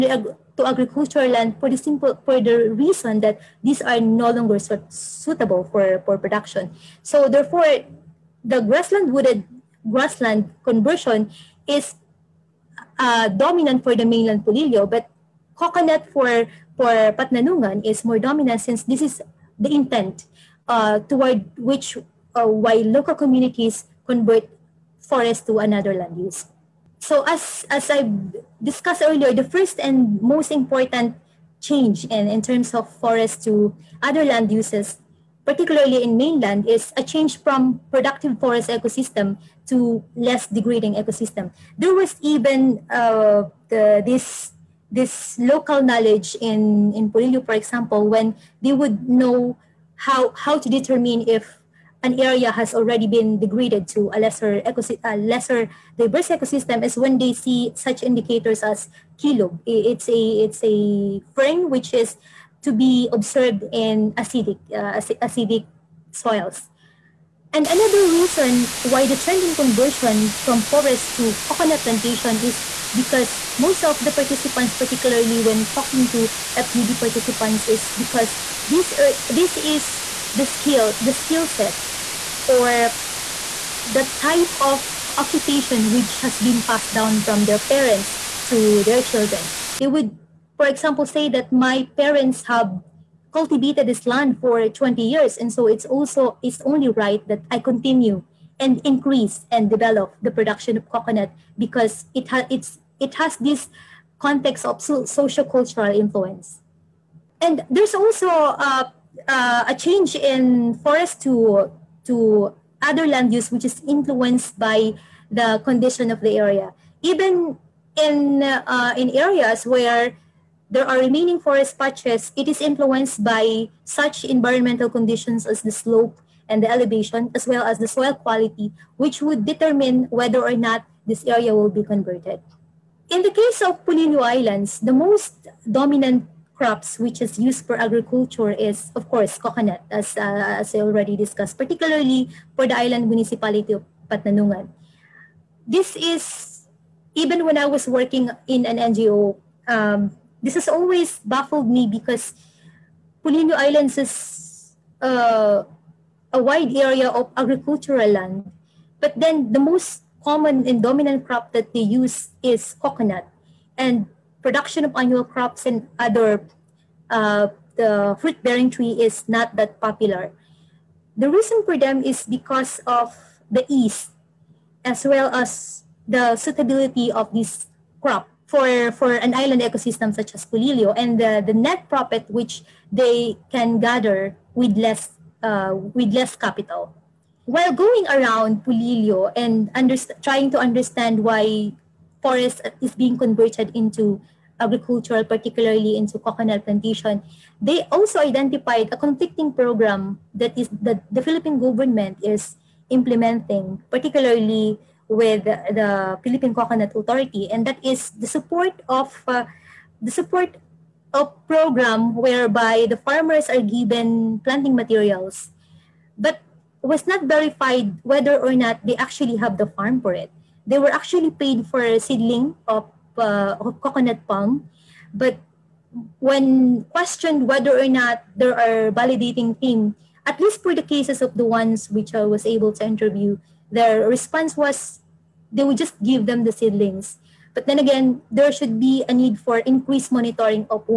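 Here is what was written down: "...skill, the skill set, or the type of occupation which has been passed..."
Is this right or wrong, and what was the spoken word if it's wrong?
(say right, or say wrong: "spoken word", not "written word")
right.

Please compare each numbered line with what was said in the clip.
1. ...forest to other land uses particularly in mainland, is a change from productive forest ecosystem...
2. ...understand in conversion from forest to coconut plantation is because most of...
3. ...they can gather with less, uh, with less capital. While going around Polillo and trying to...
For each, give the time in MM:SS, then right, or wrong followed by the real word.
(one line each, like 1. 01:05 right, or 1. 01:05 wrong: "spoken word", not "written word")
1. 00:32 right
2. 01:09 wrong: "trend", not "understand"
3. 03:02 right.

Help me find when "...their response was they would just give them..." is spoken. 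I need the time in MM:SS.
03:53.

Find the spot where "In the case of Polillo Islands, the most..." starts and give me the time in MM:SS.
02:13.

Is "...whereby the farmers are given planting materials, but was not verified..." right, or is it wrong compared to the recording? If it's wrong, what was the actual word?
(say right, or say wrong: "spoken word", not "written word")
right.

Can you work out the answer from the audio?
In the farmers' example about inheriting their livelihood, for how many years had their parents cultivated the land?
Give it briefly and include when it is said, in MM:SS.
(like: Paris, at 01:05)
20 years, at 01:34.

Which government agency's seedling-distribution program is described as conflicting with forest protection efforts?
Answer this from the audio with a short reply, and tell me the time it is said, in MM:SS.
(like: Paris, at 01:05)
Philippine Coconut Authority, at 03:26.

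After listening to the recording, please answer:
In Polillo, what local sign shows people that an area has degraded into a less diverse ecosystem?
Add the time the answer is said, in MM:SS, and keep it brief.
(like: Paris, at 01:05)
kilo, at 00:59.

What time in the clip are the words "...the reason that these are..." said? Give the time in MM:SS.
00:02.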